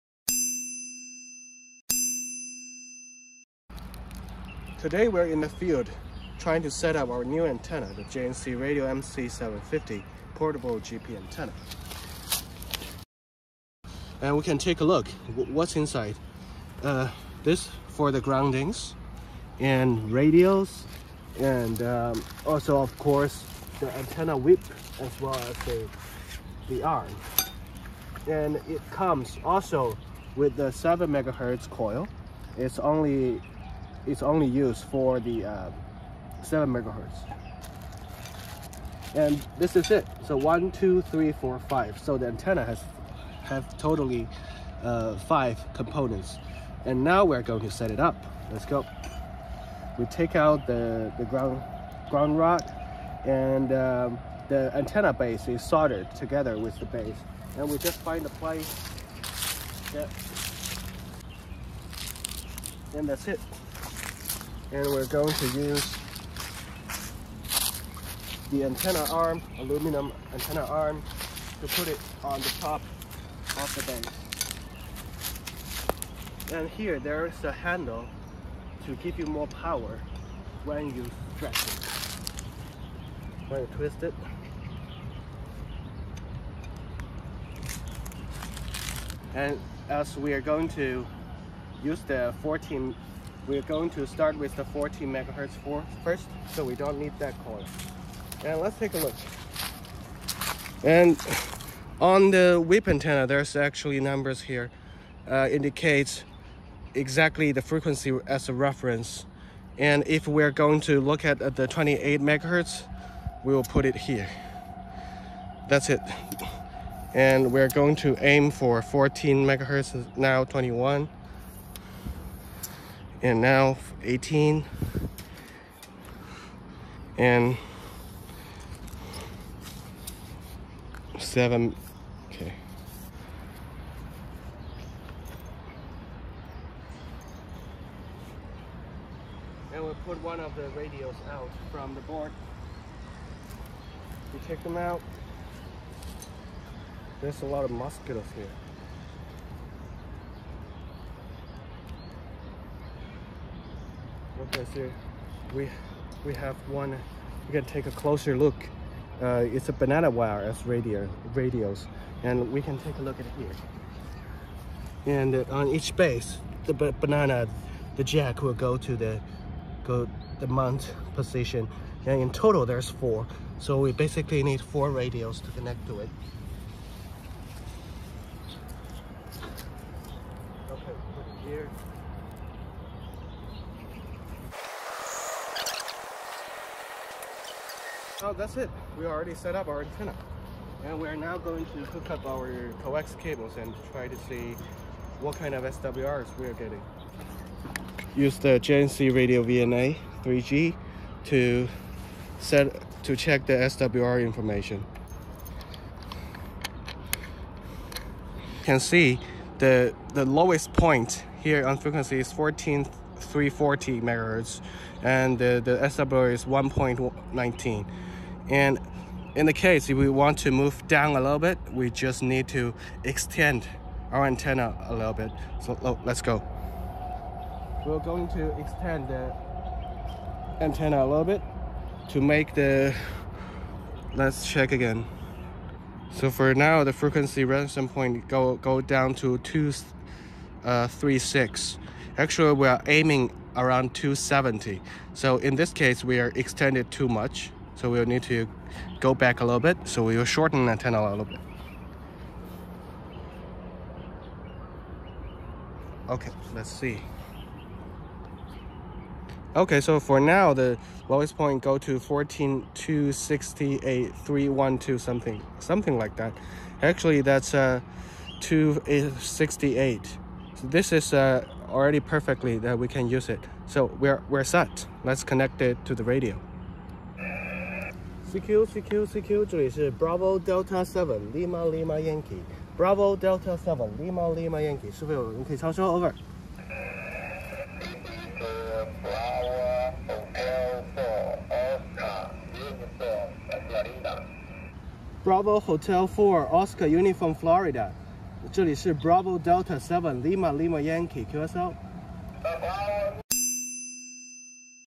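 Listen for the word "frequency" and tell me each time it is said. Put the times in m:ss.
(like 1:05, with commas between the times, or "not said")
1:47, 3:31, 3:56.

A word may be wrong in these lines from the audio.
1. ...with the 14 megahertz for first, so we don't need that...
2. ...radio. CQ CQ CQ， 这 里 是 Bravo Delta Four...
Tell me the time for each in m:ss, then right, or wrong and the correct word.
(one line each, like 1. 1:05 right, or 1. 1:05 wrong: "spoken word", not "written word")
1. 1:34 right
2. 4:36 wrong: "Seven", not "Four".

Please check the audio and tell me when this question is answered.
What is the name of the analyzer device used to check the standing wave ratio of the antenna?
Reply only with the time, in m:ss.
3:18.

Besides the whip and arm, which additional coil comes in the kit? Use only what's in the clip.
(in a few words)
7 MHz coil.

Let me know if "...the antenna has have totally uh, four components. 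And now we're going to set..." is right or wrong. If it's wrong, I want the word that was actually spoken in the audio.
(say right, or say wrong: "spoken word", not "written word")
wrong: "five", not "four".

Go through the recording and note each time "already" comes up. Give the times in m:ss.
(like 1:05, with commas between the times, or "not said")
3:09, 4:31.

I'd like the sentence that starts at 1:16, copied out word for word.
And here there is a handle to give you more power when you stretch it.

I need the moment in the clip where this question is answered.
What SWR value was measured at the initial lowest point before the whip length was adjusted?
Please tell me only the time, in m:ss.
3:36.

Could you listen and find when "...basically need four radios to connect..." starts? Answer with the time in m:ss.
2:53.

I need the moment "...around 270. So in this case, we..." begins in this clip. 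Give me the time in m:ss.
4:03.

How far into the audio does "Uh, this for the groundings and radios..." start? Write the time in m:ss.
0:16.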